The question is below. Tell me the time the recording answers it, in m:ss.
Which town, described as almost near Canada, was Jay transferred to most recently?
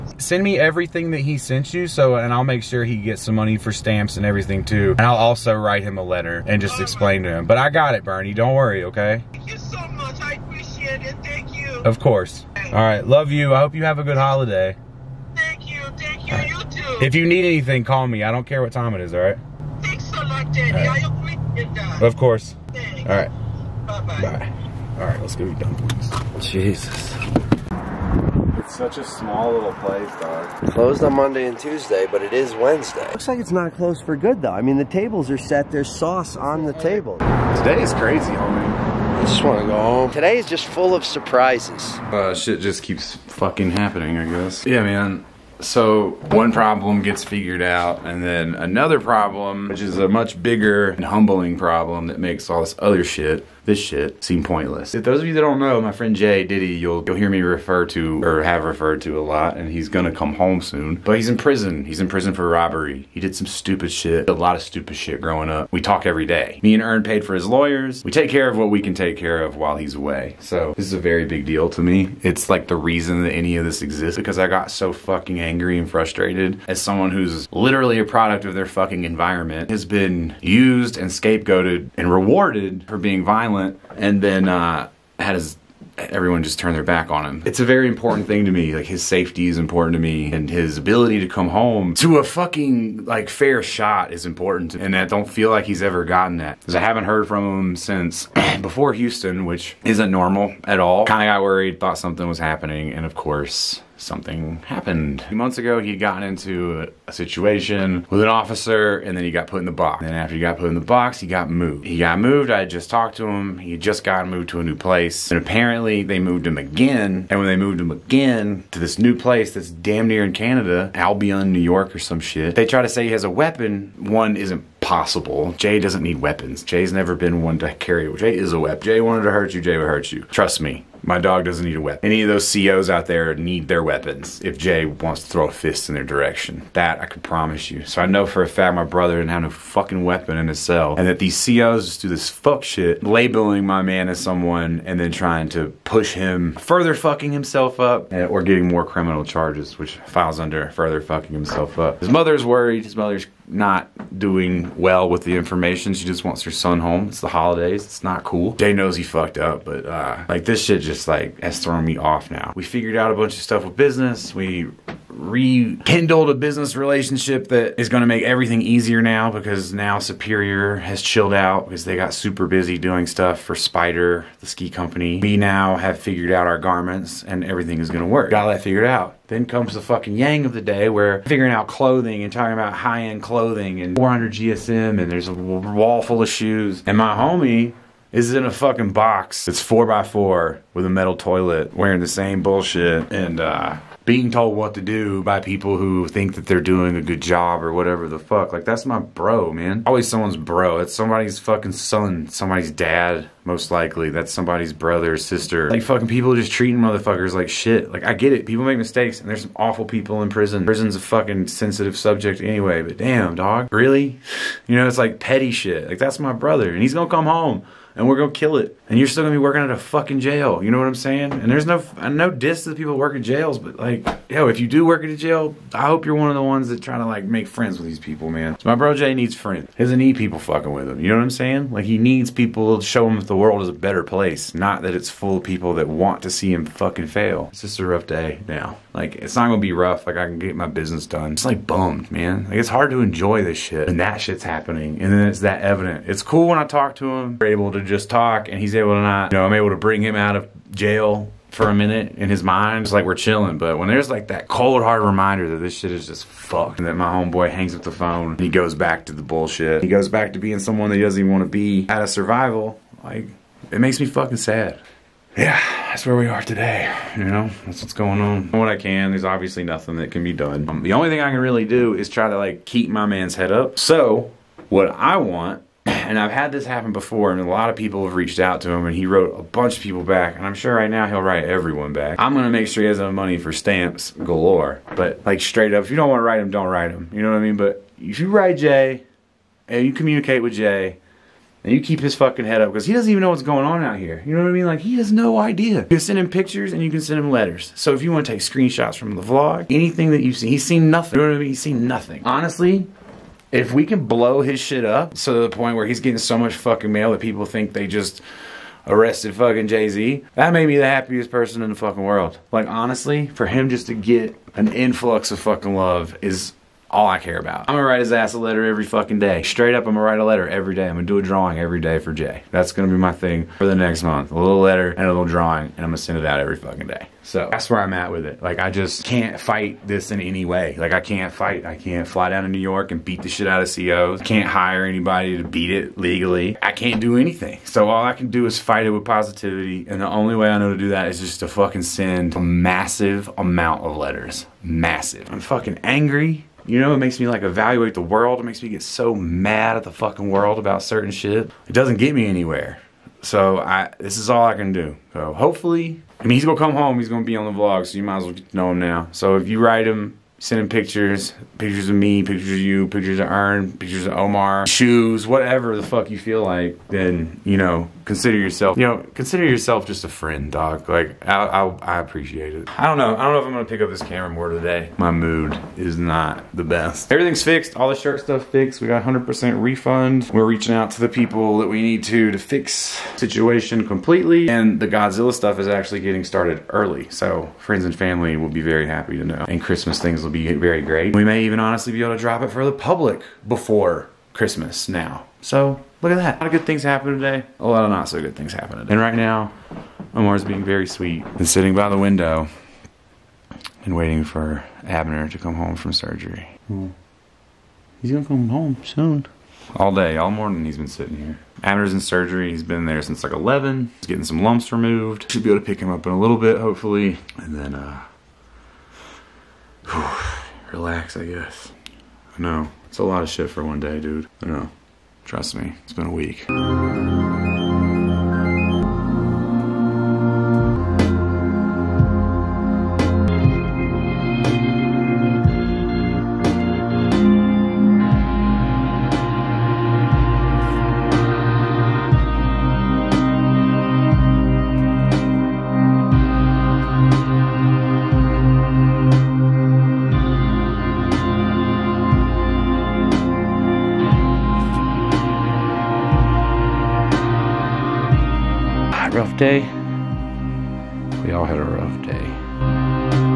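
2:00.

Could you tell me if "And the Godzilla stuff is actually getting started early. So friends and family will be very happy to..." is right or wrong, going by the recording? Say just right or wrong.
right.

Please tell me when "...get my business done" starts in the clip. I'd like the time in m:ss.
4:00.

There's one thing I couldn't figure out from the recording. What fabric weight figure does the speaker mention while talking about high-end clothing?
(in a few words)
400 GSM.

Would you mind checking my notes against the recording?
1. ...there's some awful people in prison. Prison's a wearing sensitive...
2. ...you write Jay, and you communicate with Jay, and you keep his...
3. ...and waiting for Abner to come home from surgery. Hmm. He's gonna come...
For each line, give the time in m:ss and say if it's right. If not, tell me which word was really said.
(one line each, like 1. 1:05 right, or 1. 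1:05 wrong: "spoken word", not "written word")
1. 3:29 wrong: "fucking", not "wearing"
2. 4:48 right
3. 6:43 right.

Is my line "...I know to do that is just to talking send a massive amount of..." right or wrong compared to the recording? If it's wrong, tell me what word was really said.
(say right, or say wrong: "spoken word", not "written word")
wrong: "fucking", not "talking".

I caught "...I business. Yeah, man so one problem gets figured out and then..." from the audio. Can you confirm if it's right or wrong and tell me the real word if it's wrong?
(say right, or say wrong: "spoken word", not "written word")
wrong: "guess", not "business".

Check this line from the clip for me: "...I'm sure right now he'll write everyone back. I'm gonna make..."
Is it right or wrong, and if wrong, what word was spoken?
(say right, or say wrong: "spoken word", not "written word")
right.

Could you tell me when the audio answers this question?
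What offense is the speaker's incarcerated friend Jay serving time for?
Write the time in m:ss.
1:02.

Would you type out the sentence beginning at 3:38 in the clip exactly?
And you're still gonna be working at a fucking jail.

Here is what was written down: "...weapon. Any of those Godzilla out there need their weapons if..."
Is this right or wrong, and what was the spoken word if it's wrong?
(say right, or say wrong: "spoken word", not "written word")
wrong: "COs", not "Godzilla".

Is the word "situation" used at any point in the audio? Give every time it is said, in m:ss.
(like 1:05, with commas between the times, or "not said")
1:47, 6:23.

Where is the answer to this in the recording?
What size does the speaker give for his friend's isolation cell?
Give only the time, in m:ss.
3:09.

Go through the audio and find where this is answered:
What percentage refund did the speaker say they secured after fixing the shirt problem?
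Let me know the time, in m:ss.
6:19.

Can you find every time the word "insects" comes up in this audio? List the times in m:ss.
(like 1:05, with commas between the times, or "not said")
not said.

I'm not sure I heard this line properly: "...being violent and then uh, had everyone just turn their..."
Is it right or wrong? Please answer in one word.
right.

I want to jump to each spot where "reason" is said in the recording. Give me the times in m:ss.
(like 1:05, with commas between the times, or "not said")
1:12.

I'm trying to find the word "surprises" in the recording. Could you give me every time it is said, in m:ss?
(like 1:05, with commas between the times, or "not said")
0:41.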